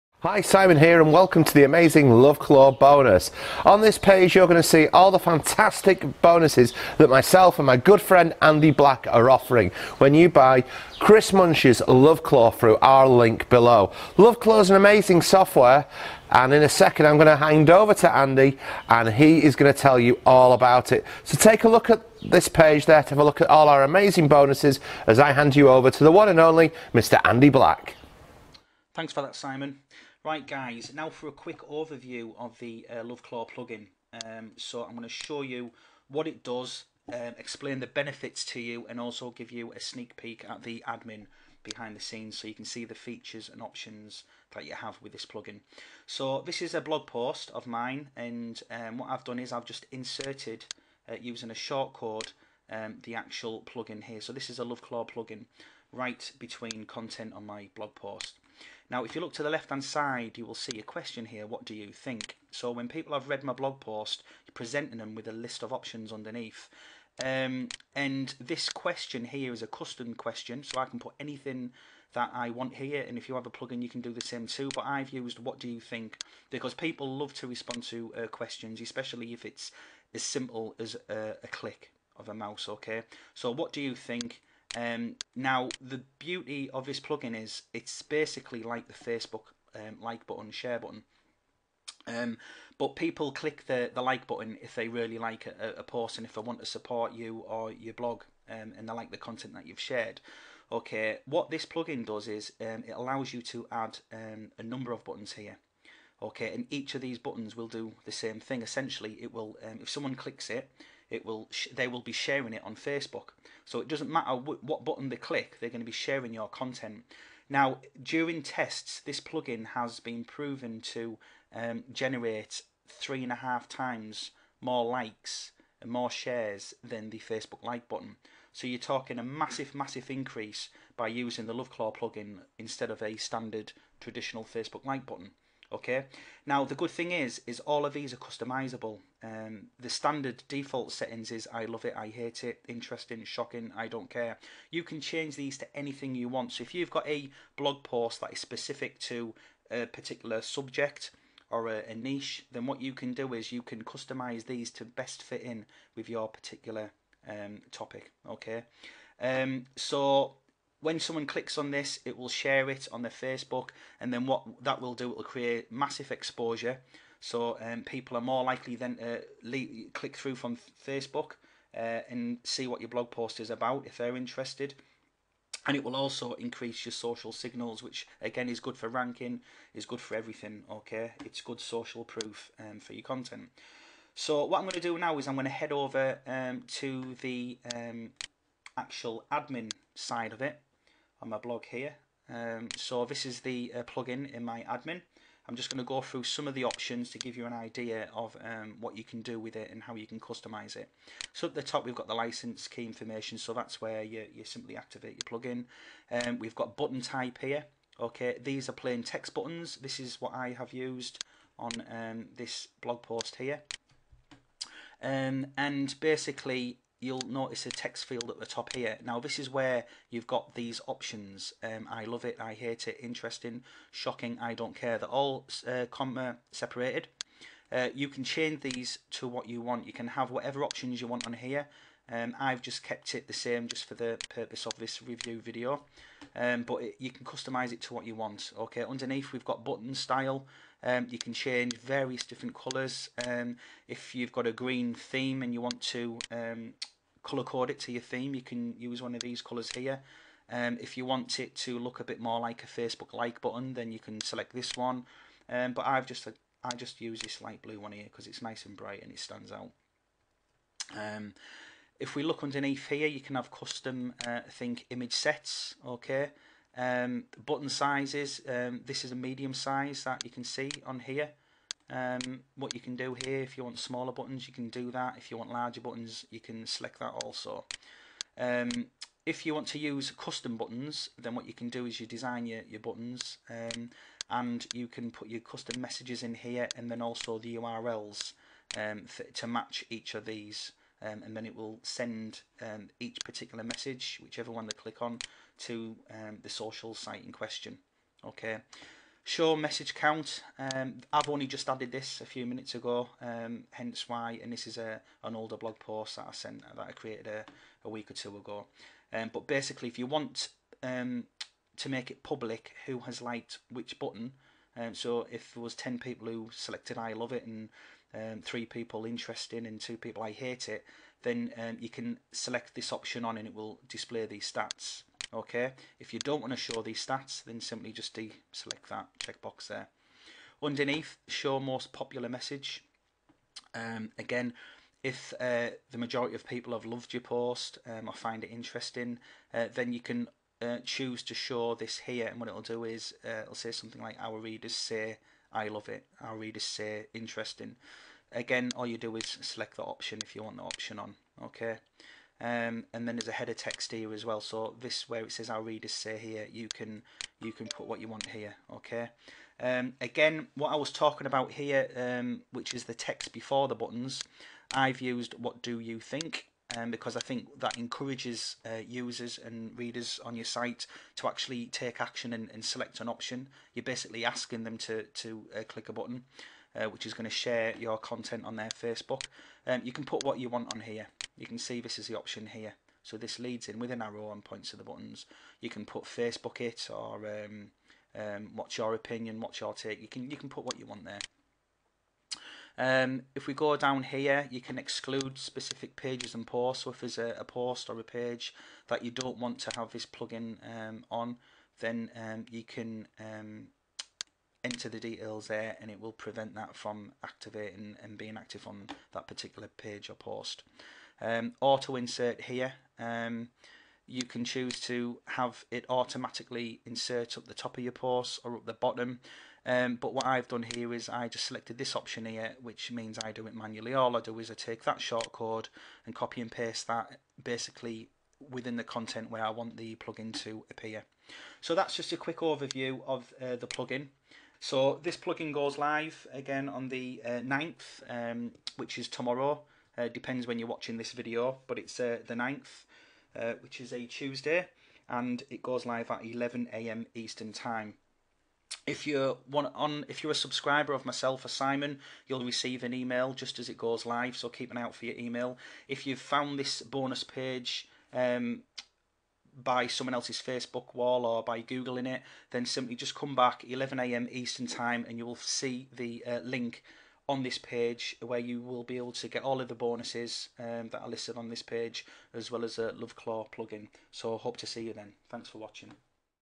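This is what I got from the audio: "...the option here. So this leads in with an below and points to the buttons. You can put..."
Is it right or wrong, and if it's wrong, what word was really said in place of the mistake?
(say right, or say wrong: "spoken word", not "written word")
wrong: "arrow", not "below".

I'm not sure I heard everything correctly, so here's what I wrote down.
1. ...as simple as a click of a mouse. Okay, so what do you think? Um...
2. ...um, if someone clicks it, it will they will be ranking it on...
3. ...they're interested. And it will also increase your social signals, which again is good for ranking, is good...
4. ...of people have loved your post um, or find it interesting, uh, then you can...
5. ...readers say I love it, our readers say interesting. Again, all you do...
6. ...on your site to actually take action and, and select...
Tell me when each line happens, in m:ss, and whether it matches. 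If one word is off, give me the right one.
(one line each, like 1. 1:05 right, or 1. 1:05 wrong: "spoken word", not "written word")
1. 1:20 right
2. 1:49 wrong: "sharing", not "ranking"
3. 2:53 right
4. 5:36 right
5. 5:44 right
6. 6:10 right.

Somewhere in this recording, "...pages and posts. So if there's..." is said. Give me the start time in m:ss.
6:35.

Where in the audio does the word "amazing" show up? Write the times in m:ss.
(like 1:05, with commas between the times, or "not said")
0:01, 0:14, 0:23.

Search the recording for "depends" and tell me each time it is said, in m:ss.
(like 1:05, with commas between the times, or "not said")
7:20.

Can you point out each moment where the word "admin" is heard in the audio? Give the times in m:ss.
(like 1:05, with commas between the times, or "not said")
0:40, 3:09, 3:14.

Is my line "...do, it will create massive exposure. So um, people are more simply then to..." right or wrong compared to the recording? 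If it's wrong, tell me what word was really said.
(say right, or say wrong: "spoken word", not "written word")
wrong: "likely", not "simply".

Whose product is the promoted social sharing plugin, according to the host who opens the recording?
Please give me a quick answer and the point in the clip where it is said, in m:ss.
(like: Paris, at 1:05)
Chris Munch, at 0:10.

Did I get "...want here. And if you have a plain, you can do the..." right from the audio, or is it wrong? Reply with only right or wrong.
wrong.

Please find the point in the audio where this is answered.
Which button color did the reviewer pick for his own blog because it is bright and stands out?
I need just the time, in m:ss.
4:17.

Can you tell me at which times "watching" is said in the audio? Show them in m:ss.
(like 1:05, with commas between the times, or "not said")
7:20, 7:55.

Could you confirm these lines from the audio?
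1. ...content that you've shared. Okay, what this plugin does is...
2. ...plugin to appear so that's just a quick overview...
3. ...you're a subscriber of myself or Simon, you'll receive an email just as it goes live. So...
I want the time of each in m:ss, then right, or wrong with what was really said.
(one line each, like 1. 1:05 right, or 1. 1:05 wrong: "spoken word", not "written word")
1. 1:39 right
2. 7:09 right
3. 7:30 right.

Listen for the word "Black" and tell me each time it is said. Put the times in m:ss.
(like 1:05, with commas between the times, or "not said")
0:08, 0:27.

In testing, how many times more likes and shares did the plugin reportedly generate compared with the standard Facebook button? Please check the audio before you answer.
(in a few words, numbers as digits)
3.5.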